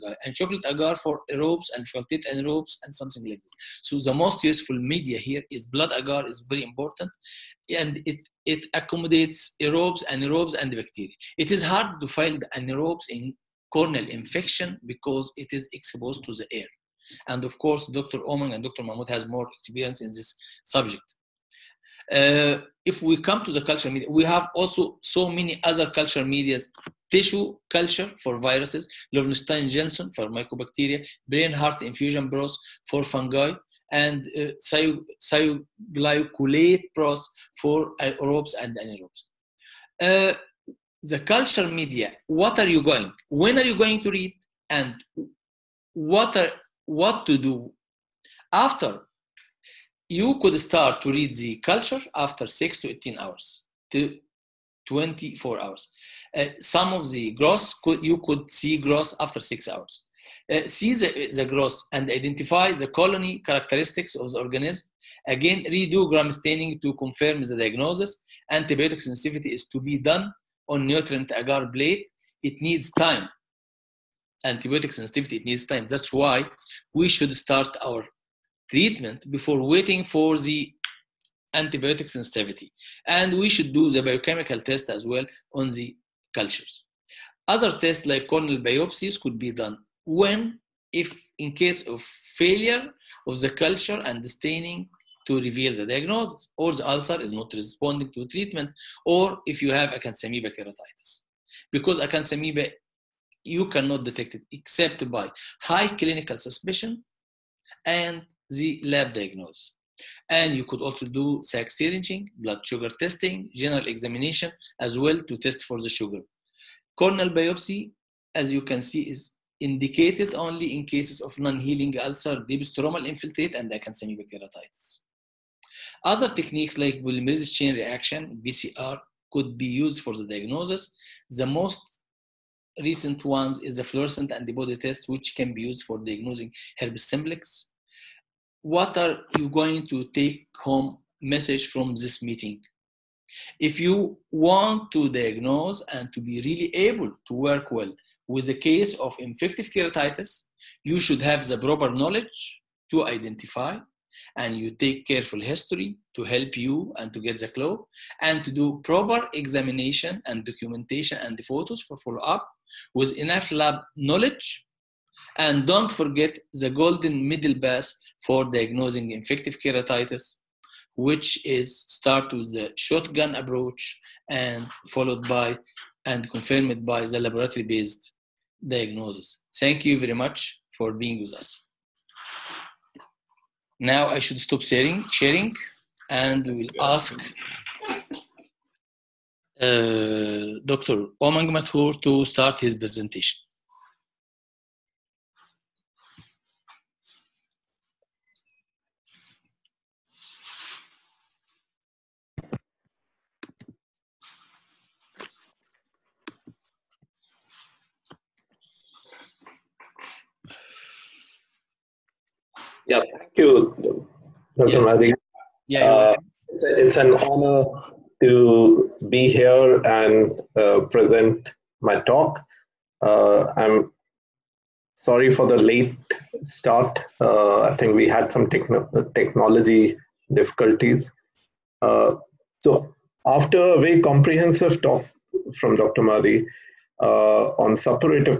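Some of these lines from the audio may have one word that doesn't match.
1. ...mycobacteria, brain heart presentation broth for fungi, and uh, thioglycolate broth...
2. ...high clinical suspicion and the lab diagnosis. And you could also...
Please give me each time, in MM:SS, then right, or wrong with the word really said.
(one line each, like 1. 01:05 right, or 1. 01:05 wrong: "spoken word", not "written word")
1. 00:30 wrong: "infusion", not "presentation"
2. 01:45 right.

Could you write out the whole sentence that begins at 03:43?
Uh, I'm sorry for the late start.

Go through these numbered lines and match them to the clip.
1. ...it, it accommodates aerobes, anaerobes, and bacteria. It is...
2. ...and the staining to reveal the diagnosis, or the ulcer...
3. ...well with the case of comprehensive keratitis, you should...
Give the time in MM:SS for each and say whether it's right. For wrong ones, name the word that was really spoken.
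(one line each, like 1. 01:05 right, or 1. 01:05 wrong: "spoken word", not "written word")
1. 00:08 right
2. 01:34 right
3. 02:27 wrong: "infective", not "comprehensive".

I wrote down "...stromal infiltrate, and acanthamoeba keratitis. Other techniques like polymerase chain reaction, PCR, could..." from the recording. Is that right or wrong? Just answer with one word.
right.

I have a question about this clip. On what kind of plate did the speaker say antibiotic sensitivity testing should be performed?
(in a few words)
nutrient agar plate.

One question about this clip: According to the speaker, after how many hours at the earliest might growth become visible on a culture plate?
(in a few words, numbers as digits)
6 hours.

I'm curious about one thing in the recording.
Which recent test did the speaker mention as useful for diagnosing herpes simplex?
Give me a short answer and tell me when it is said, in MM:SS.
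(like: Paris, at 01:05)
fluorescent antibody test, at 02:13.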